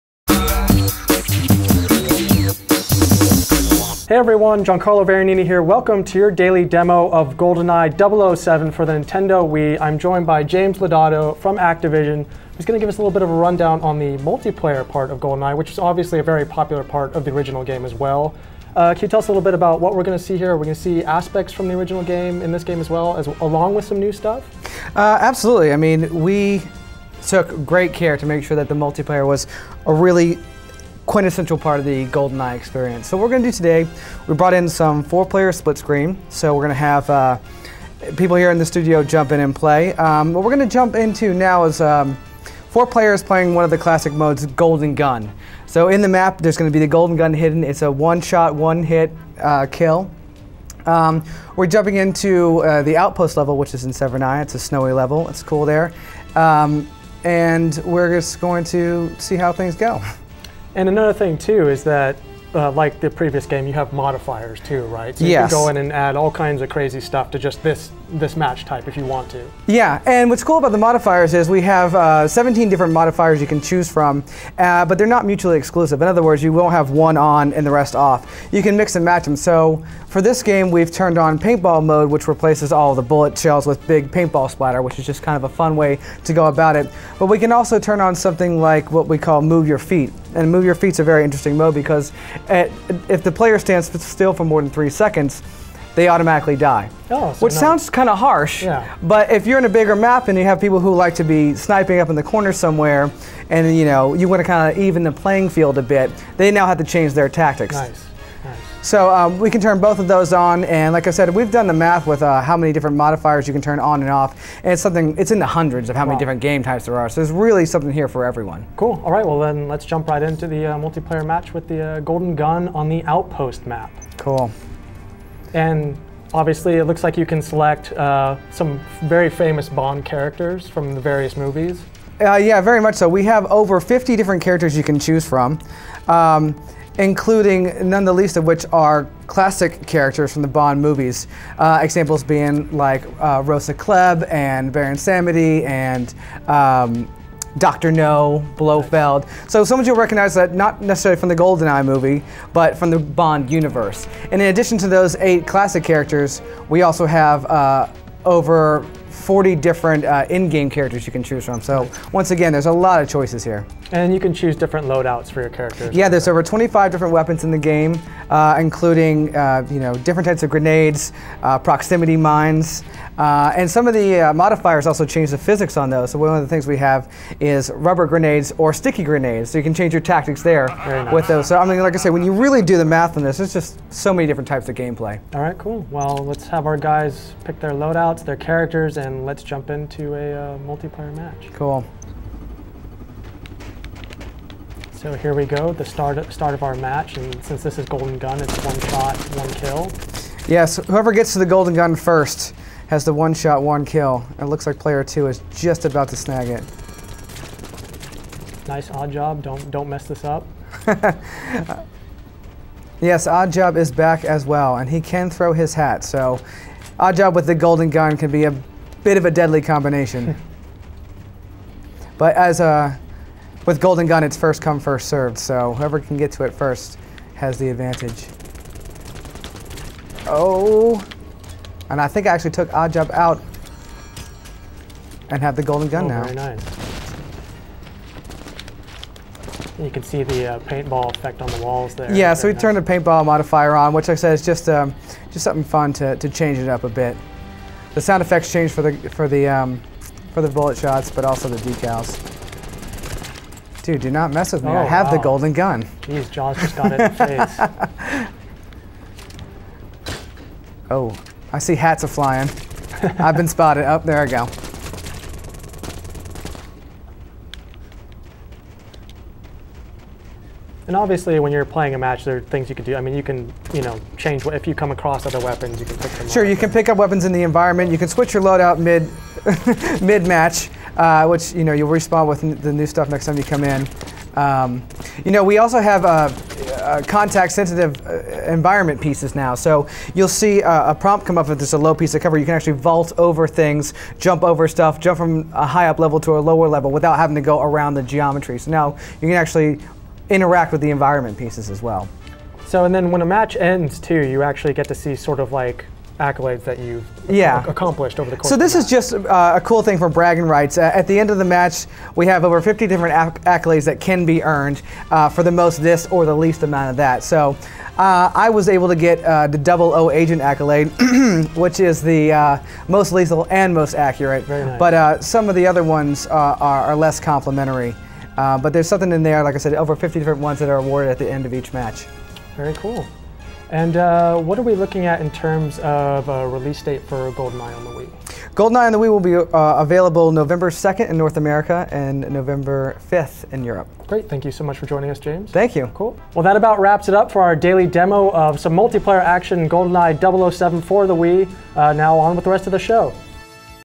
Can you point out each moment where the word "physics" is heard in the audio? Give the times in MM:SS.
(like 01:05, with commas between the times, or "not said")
02:55.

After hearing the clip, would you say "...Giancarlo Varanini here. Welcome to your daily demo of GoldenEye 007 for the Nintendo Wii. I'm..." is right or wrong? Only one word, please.
right.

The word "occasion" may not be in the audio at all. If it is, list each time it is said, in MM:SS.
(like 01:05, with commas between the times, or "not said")
not said.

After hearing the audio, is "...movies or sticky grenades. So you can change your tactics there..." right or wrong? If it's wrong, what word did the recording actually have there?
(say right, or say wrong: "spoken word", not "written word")
wrong: "grenades", not "movies".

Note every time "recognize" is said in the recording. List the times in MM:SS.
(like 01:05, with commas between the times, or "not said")
02:29.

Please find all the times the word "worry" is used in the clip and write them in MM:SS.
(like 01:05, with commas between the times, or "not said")
not said.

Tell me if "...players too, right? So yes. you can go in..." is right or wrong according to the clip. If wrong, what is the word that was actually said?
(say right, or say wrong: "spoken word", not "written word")
wrong: "modifiers", not "players".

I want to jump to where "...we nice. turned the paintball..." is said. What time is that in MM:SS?
04:02.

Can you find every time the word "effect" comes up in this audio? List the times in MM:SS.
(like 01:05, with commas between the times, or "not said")
04:01, 04:08.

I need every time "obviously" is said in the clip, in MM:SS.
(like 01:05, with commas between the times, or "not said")
00:15, 02:06, 04:30.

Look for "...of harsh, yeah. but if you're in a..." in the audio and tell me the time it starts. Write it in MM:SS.
01:38.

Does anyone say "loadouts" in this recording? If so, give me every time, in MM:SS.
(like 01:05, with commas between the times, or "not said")
02:44, 03:07, 04:38.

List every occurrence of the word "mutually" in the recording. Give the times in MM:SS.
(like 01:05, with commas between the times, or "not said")
01:15.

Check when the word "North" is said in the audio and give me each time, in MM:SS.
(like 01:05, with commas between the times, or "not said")
05:41.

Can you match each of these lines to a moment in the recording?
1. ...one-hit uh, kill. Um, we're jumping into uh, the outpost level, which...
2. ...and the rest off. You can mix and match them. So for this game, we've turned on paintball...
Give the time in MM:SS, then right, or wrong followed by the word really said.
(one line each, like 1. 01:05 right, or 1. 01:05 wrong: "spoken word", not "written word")
1. 00:48 right
2. 01:17 right.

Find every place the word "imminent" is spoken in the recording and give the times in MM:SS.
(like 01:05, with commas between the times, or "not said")
not said.